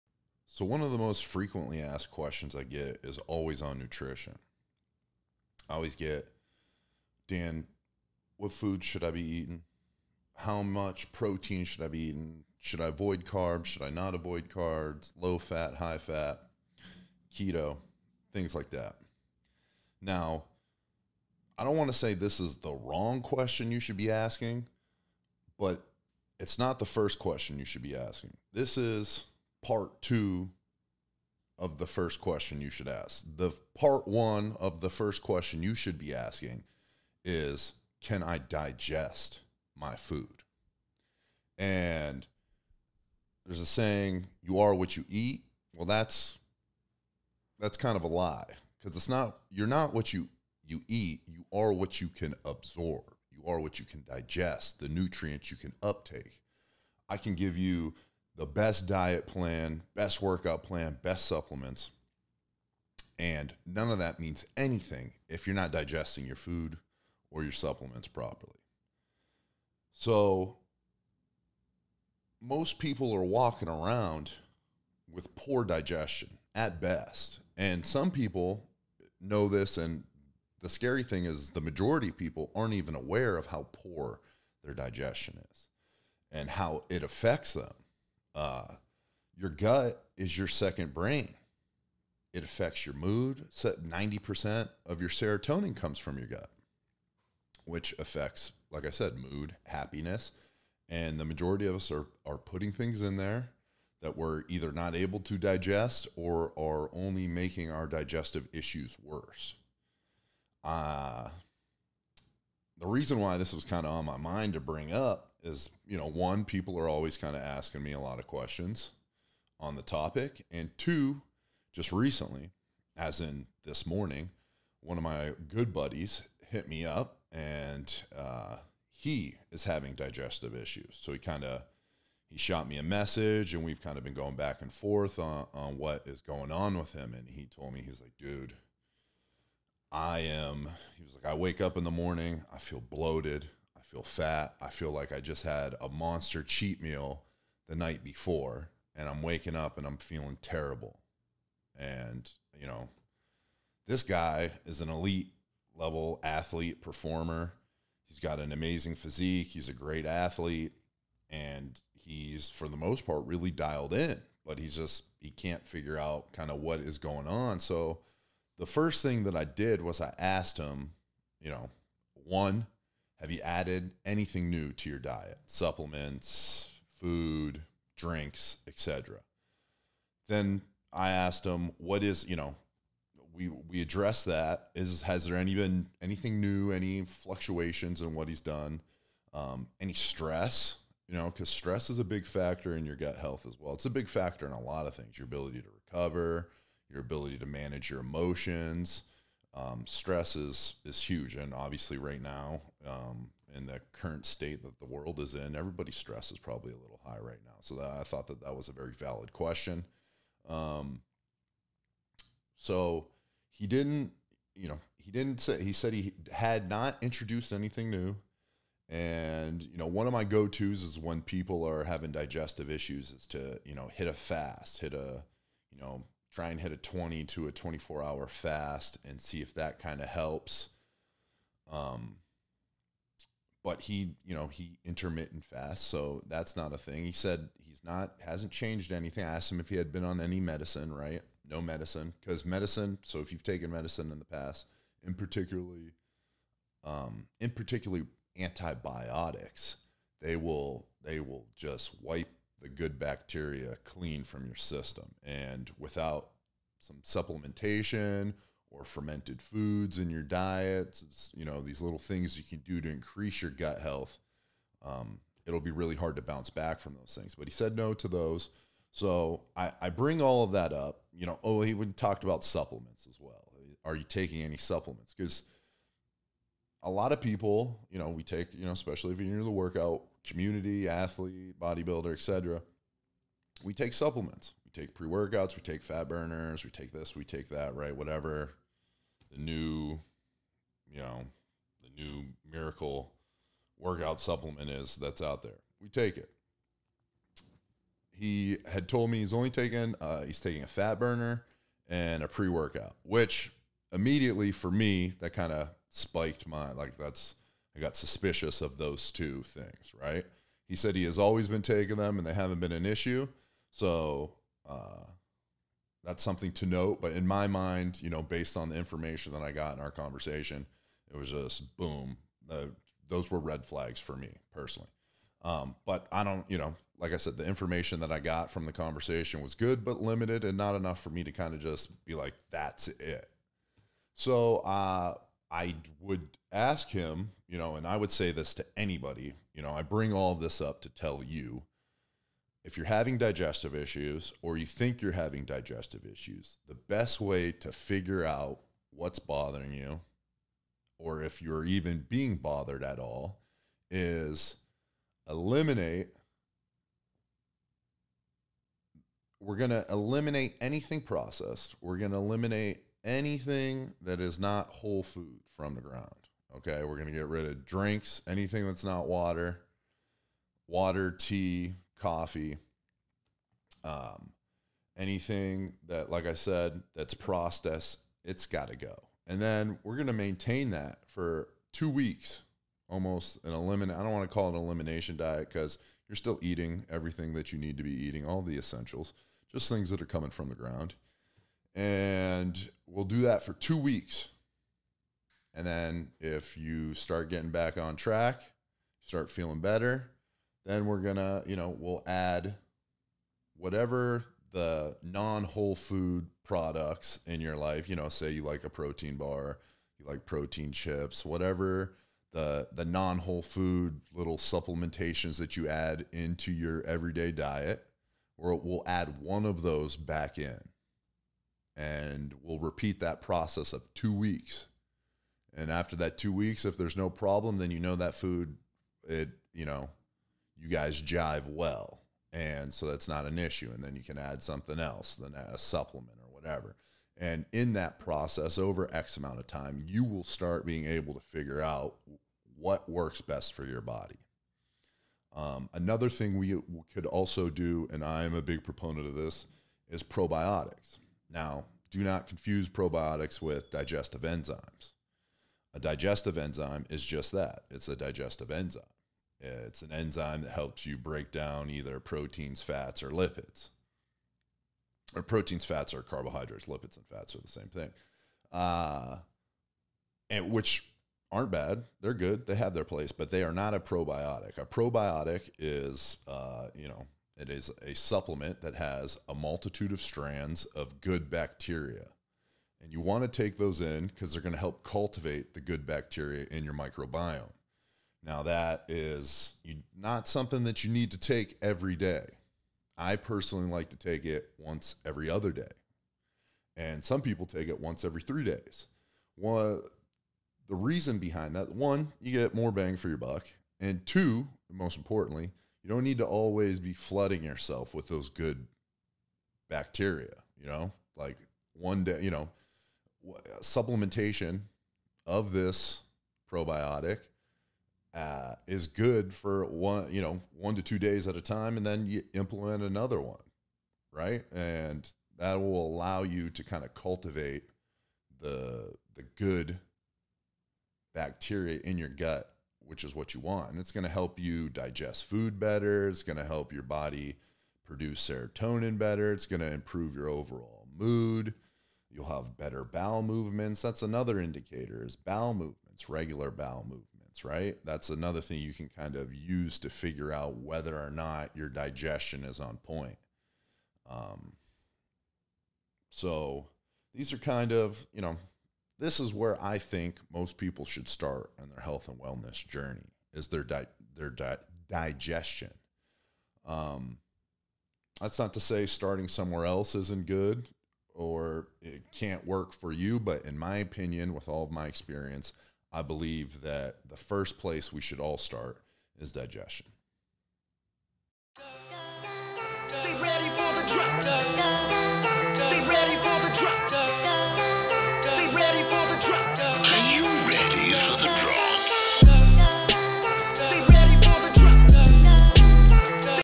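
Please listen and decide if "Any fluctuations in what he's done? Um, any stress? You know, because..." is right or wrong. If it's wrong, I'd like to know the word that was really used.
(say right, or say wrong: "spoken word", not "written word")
right.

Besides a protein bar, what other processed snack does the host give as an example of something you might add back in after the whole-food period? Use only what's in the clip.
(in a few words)
protein chips.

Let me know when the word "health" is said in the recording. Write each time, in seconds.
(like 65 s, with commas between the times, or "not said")
193 s, 263 s, 561 s.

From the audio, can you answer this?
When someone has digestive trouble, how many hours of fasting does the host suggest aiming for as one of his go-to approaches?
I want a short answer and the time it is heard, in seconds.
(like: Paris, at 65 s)
20 to 24 hours, at 226 s.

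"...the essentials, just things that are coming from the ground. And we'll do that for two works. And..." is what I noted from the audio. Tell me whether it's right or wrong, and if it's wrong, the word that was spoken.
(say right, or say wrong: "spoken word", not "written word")
wrong: "weeks", not "works".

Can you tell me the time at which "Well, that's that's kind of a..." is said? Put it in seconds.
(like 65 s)
45 s.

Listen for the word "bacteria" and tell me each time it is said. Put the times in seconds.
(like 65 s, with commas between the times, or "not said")
252 s, 481 s, 485 s, 509 s, 531 s.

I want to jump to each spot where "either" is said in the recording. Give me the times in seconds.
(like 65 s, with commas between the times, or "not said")
104 s, 461 s.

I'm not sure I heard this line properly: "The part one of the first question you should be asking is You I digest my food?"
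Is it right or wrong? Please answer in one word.
wrong.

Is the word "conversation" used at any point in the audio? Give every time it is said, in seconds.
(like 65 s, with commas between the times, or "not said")
319 s, 328 s.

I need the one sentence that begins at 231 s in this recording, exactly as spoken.
Um, but he, you know, he intermittent fast, so that's not a thing.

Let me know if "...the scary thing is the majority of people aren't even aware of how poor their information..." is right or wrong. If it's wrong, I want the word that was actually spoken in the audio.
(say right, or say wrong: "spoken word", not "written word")
wrong: "digestion", not "information".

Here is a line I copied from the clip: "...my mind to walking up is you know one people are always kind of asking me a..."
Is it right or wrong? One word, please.
wrong.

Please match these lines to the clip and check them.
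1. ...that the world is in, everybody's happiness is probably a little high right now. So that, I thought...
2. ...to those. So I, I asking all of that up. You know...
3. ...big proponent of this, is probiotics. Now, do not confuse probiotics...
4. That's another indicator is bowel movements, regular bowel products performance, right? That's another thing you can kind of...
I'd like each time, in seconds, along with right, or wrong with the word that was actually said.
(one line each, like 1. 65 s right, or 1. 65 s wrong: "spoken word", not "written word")
1. 204 s wrong: "stress", not "happiness"
2. 267 s wrong: "bring", not "asking"
3. 448 s right
4. 543 s wrong: "movements", not "products".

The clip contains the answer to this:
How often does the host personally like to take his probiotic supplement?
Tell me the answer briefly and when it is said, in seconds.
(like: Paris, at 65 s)
once every other day, at 494 s.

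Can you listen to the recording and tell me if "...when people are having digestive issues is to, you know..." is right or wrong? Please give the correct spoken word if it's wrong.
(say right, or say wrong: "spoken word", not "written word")
right.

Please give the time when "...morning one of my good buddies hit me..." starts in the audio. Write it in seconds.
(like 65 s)
123 s.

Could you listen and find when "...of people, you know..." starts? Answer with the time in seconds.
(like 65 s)
277 s.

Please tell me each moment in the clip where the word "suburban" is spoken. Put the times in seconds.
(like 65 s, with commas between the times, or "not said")
not said.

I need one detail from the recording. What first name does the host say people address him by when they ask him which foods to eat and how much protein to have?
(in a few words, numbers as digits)
Dan.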